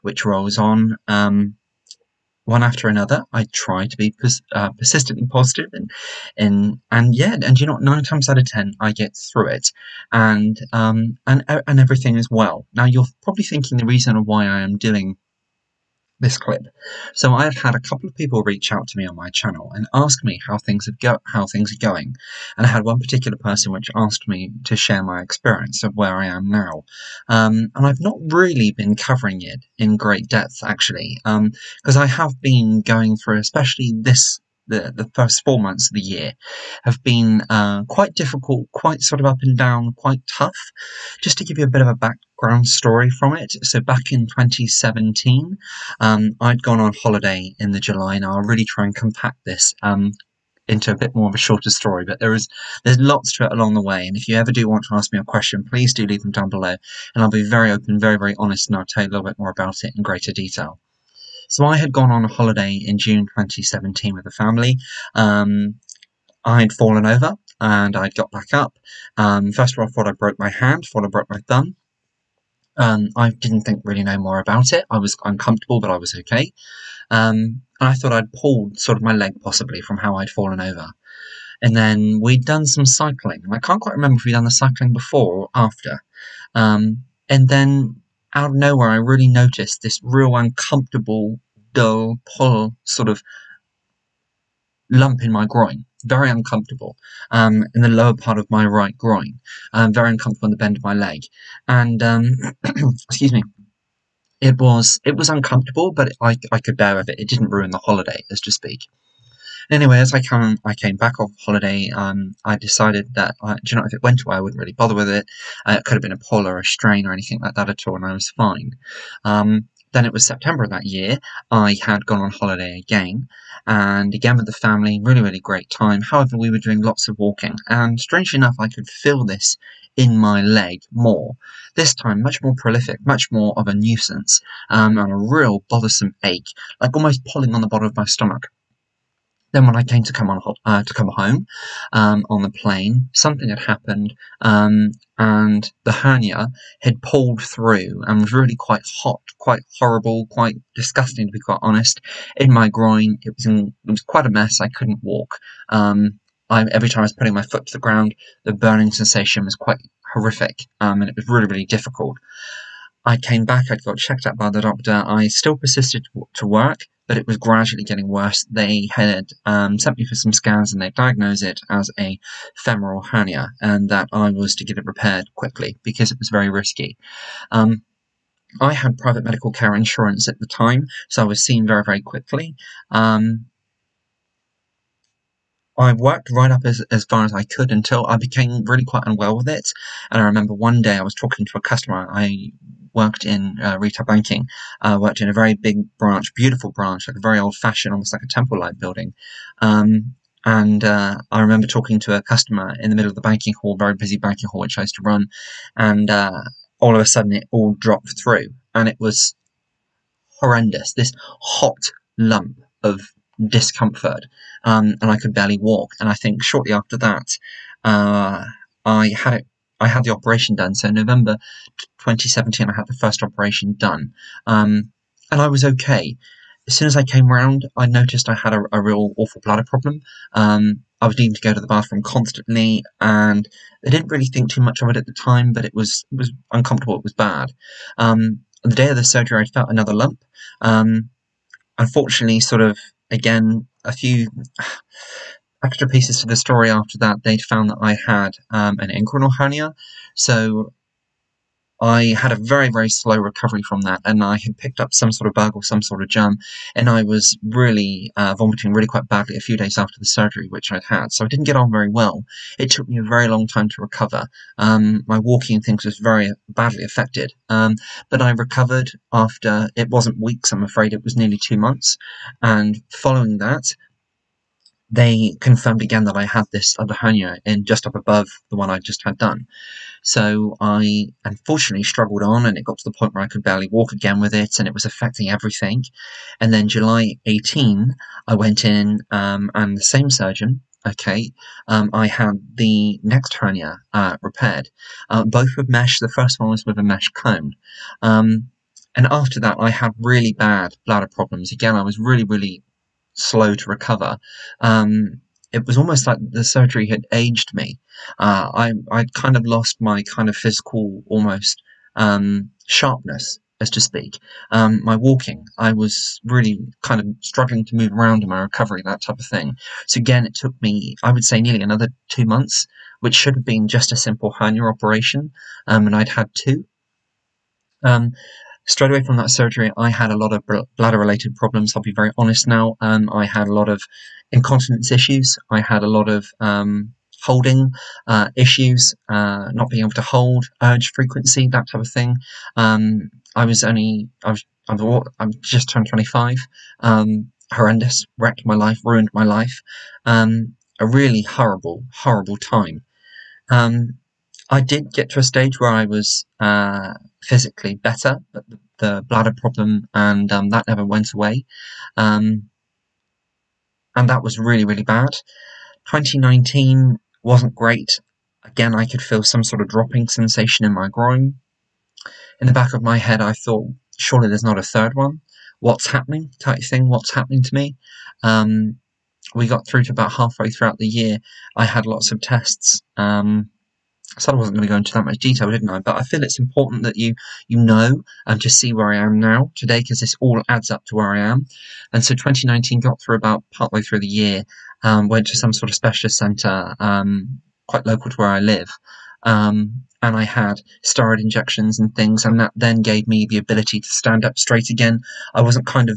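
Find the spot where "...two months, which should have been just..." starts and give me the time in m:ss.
5:22.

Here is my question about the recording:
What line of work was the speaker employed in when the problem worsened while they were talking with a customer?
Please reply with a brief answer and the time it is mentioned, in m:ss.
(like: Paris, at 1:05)
retail banking, at 3:13.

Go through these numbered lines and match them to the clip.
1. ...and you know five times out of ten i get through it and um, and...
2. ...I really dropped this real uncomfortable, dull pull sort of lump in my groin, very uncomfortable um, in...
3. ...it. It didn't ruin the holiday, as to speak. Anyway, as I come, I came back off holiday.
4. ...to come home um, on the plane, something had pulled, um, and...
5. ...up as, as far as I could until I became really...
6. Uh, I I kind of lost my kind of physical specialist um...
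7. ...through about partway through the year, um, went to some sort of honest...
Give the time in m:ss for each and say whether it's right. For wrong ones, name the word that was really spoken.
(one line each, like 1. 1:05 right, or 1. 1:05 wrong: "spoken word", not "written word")
1. 0:07 wrong: "nine", not "five"
2. 1:28 wrong: "noticed", not "dropped"
3. 1:47 right
4. 2:20 wrong: "happened", not "pulled"
5. 3:06 right
6. 5:08 wrong: "almost", not "specialist"
7. 6:33 wrong: "specialist", not "honest".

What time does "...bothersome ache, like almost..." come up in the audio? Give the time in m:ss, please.
2:15.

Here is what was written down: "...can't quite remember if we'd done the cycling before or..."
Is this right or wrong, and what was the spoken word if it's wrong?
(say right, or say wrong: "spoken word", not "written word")
right.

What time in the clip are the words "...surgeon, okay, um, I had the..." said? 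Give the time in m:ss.
4:50.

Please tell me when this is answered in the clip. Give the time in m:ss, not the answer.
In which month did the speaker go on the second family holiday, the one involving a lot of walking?
2:00.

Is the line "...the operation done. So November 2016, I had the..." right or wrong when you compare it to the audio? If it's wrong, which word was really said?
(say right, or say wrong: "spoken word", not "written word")
wrong: "2017", not "2016".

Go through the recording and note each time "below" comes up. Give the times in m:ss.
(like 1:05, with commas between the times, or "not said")
0:56.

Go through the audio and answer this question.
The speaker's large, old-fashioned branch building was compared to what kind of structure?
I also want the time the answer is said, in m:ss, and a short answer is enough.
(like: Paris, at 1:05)
a temple, at 3:18.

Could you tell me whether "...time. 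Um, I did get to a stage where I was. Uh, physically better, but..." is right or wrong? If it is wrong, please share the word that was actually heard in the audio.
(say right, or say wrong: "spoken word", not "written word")
right.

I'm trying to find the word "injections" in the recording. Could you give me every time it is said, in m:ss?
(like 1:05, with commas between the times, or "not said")
6:41.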